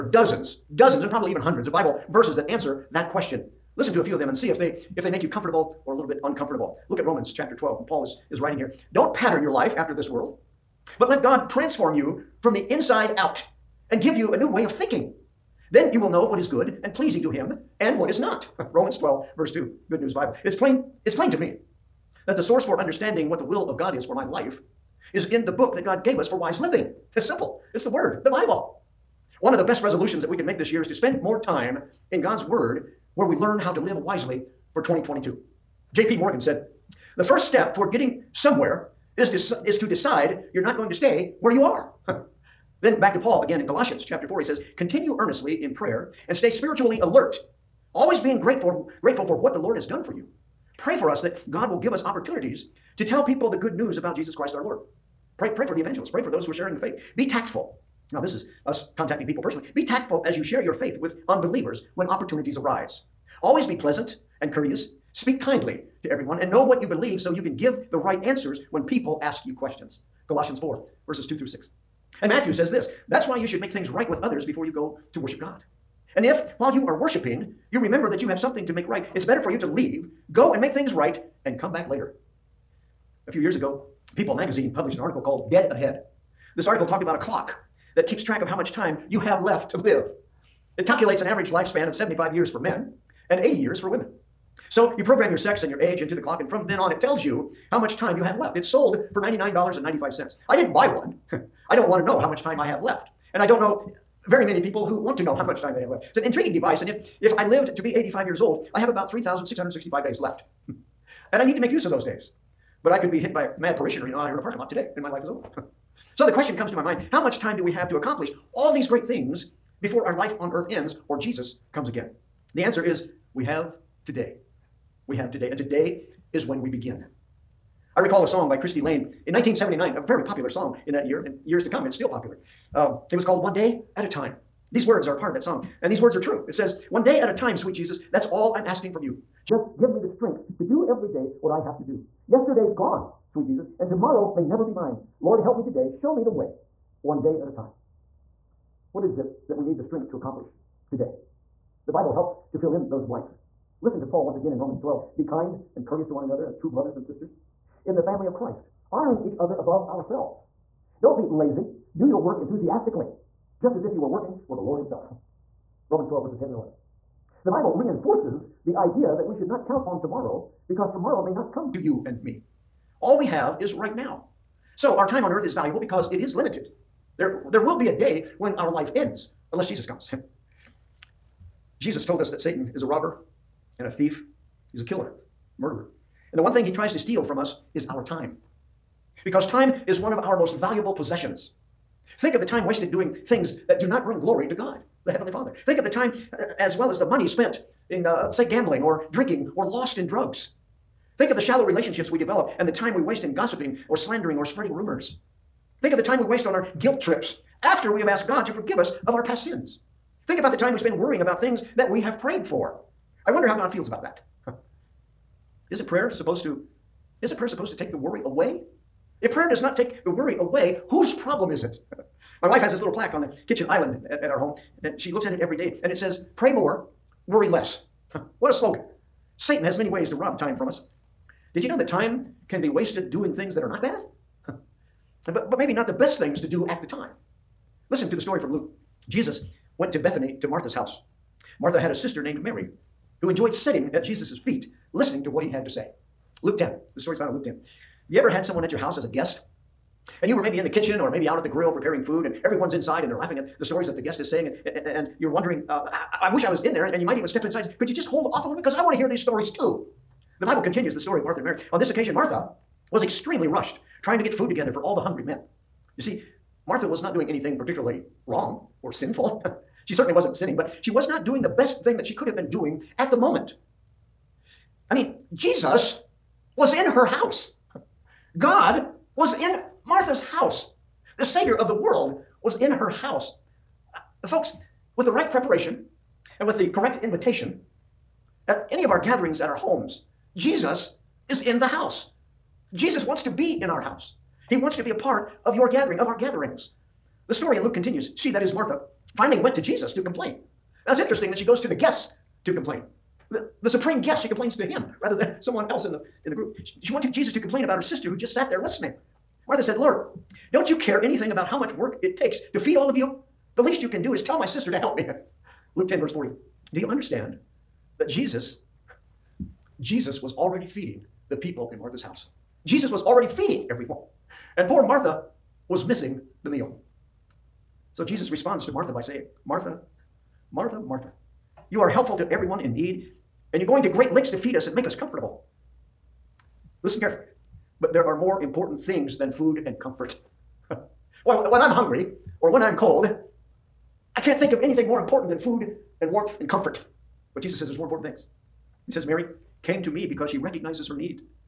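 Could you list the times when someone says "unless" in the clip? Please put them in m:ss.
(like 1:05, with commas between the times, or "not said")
2:59.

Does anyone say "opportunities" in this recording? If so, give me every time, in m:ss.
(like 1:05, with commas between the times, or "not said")
0:52, 1:02.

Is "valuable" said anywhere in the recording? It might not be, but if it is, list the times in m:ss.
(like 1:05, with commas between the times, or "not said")
2:55, 3:10.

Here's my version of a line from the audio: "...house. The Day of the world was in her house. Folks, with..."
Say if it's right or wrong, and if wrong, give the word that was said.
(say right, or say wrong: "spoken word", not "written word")
wrong: "Savior", not "Day".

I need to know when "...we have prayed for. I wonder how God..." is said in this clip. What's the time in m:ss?
3:31.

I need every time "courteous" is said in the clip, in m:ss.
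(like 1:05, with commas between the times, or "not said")
1:04, 2:35.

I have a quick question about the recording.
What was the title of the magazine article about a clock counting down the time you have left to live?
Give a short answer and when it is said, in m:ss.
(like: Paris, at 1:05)
Dead Ahead, at 1:25.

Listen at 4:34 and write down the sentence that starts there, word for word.
I mean, Jesus was in her house.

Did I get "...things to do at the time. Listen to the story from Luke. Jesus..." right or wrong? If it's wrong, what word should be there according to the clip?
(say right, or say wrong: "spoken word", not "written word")
right.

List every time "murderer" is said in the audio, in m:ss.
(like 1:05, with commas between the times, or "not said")
3:05.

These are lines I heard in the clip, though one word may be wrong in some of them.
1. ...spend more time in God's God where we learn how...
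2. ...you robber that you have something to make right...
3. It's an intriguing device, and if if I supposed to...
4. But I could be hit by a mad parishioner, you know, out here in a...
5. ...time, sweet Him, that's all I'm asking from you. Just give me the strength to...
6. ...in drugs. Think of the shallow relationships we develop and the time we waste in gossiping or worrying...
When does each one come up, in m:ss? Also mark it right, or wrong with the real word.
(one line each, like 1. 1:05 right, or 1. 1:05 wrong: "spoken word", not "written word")
1. 0:30 wrong: "Word", not "God"
2. 1:17 wrong: "remember", not "robber"
3. 1:46 wrong: "lived", not "supposed"
4. 1:52 right
5. 2:17 wrong: "Jesus", not "Him"
6. 3:19 wrong: "slandering", not "worrying".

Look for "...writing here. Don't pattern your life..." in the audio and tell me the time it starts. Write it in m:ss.
0:08.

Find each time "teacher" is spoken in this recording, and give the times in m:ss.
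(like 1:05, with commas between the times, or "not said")
not said.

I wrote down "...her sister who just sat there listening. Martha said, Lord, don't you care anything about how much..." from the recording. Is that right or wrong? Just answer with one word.
right.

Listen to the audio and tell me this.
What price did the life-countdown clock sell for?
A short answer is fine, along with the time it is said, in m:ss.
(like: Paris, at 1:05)
$99.95, at 1:39.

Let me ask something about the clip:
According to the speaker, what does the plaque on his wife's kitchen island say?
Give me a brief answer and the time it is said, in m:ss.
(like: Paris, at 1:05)
Pray more, worry less, at 3:46.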